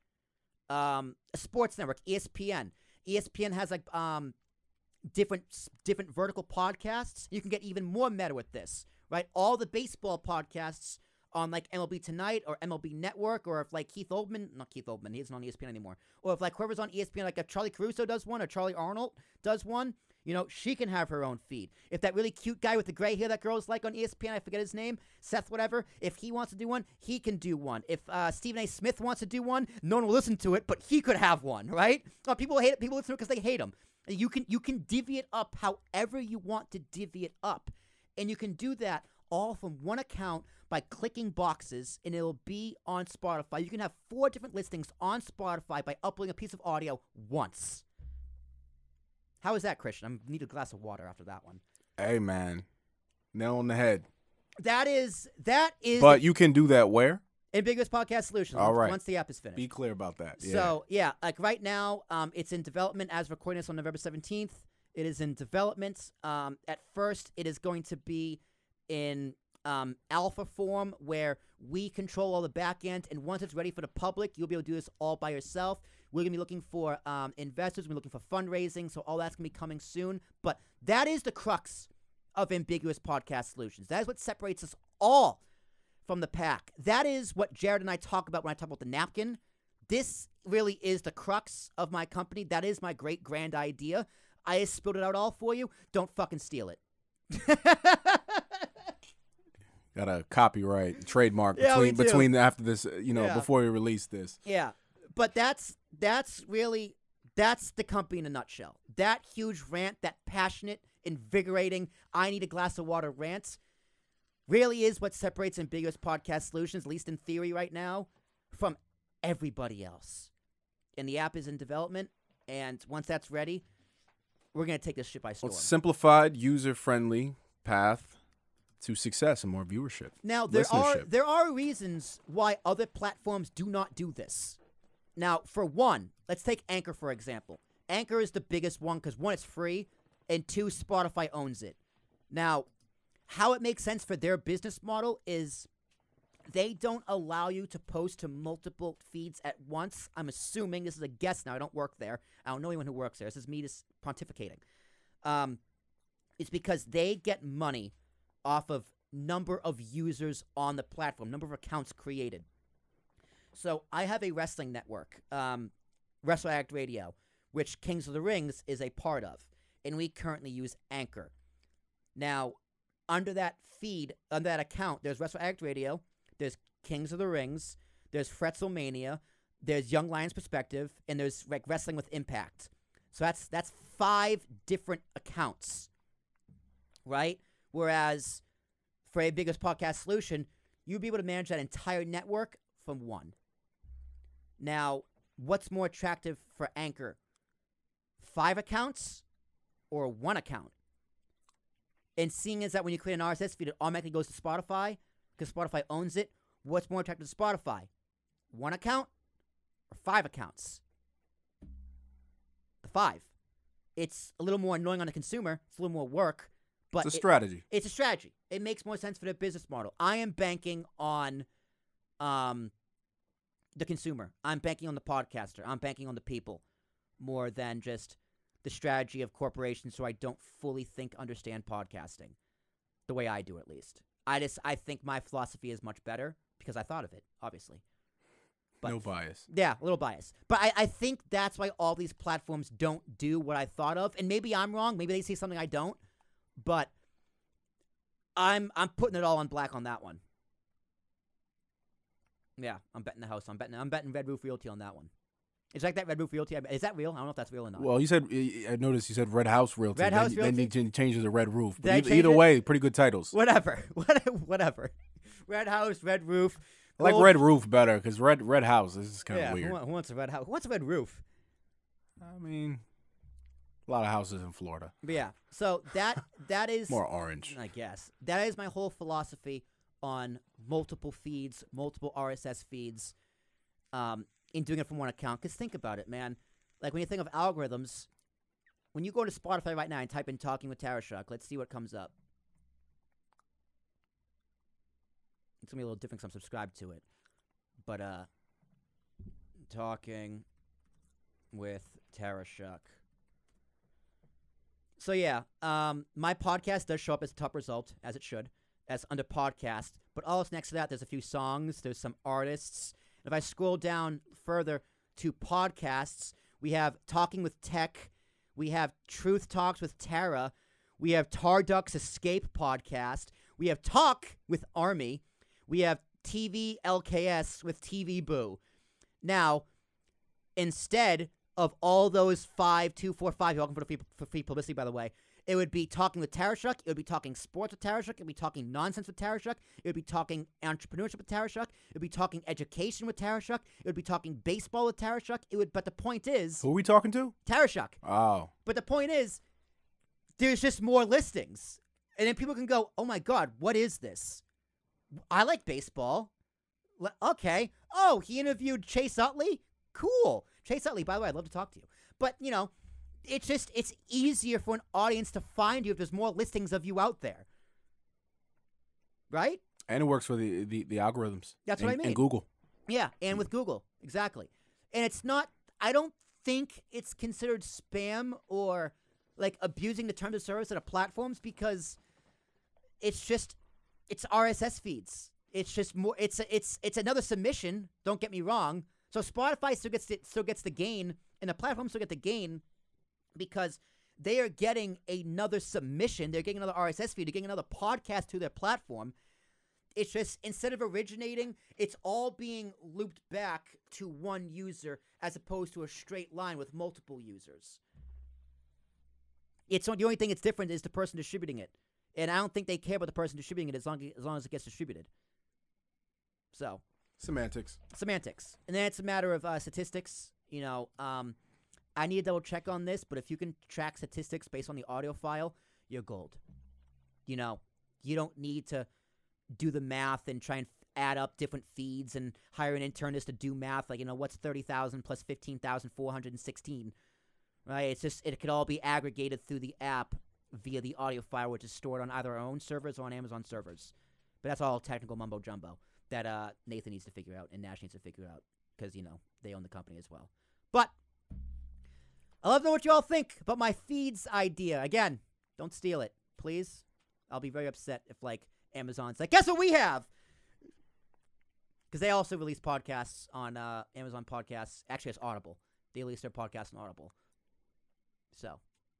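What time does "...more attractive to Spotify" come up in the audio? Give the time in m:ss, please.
3:26.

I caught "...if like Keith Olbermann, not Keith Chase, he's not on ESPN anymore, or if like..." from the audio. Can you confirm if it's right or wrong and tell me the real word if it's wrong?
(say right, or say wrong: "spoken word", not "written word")
wrong: "Olbermann", not "Chase".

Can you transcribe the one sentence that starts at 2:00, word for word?
And the app is in development, and once that's ready, we're gonna take this shit by storm.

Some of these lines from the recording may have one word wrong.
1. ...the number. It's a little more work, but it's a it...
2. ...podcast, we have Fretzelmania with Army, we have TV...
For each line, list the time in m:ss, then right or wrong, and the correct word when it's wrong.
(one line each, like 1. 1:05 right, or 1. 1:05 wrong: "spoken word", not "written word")
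1. 3:35 wrong: "consumer", not "number"
2. 5:22 wrong: "Talk", not "Fretzelmania".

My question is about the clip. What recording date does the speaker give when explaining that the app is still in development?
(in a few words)
November 17.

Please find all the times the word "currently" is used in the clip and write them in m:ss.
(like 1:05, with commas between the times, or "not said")
2:50.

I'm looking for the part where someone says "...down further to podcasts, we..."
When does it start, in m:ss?
5:13.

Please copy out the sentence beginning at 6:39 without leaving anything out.
It's just instead of originating, it's all being looped back to one user as opposed to a straight line with multiple users.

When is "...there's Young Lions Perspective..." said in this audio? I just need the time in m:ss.
2:59.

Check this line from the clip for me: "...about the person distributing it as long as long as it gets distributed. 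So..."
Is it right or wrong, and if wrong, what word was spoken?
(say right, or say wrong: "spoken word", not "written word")
right.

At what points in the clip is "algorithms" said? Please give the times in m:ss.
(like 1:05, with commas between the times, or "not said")
4:47, 6:10.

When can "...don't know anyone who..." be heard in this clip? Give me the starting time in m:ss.
2:32.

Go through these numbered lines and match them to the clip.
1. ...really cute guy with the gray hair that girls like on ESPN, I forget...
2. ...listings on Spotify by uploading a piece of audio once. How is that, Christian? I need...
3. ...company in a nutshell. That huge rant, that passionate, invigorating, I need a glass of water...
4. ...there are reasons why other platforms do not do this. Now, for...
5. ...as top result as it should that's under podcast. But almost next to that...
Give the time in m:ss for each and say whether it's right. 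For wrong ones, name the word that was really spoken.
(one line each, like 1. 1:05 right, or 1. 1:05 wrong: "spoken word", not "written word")
1. 0:22 right
2. 0:44 right
3. 1:47 right
4. 2:11 right
5. 5:07 right.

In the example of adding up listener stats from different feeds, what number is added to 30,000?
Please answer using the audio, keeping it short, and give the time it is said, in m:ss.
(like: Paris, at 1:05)
15,416, at 7:15.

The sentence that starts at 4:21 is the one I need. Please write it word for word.
But either, either way, pretty good titles.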